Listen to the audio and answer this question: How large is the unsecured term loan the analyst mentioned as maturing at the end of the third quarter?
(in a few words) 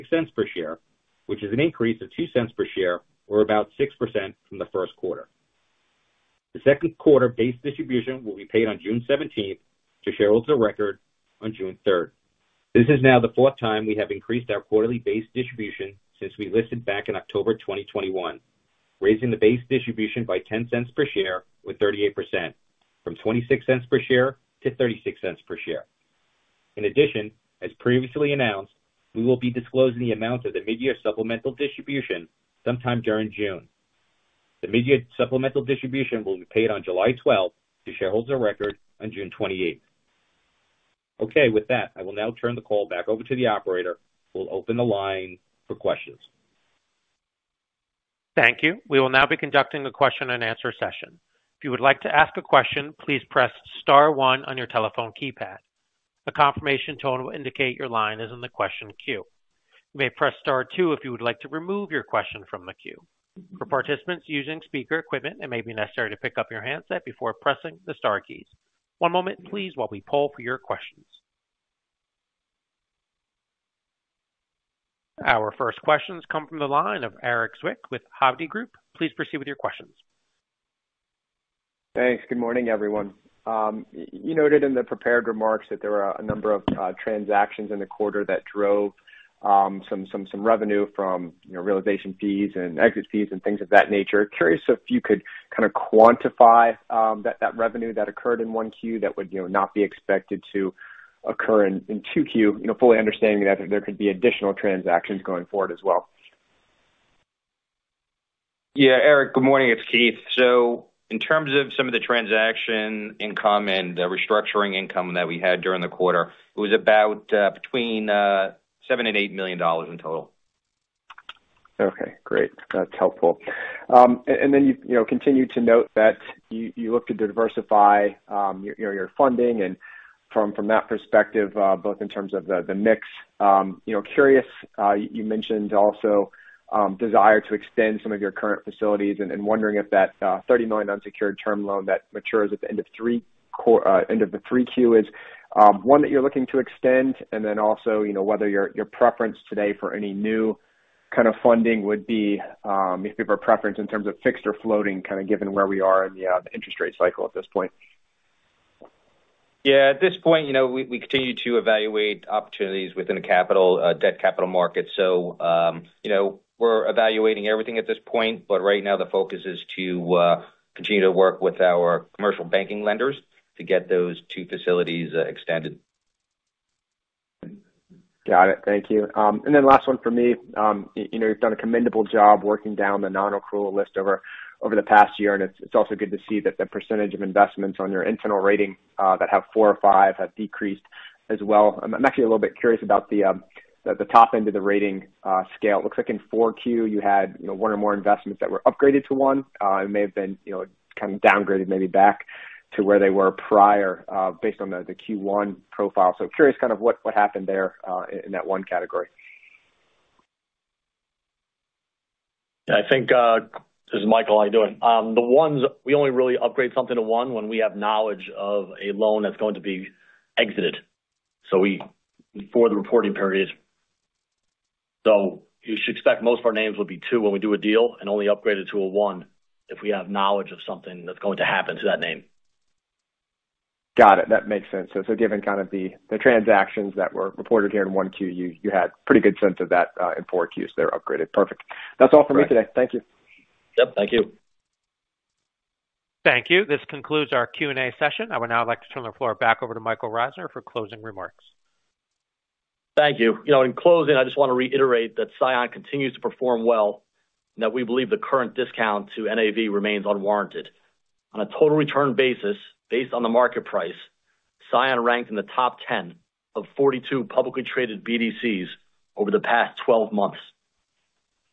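$30 million.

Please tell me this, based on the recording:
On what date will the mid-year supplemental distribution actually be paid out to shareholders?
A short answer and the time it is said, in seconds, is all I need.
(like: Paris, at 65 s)
July 12th, at 36 s.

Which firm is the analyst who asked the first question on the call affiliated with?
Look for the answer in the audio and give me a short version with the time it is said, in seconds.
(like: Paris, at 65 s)
Hovde Group, at 78 s.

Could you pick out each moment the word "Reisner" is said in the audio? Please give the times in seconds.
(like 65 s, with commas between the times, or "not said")
250 s.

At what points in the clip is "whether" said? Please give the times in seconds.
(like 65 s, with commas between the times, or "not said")
148 s.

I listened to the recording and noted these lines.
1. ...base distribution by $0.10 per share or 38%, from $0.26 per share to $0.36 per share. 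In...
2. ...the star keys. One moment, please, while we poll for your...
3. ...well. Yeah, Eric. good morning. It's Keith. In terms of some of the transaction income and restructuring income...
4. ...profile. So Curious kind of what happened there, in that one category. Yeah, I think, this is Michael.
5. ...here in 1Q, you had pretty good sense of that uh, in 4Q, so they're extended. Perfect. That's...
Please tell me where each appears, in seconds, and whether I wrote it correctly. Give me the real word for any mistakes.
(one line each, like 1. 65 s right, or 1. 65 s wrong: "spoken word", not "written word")
1. 19 s right
2. 67 s right
3. 105 s right
4. 205 s right
5. 237 s wrong: "upgraded", not "extended".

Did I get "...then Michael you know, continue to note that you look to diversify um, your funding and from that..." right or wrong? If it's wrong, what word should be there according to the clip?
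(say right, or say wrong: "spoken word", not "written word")
wrong: "You", not "Michael".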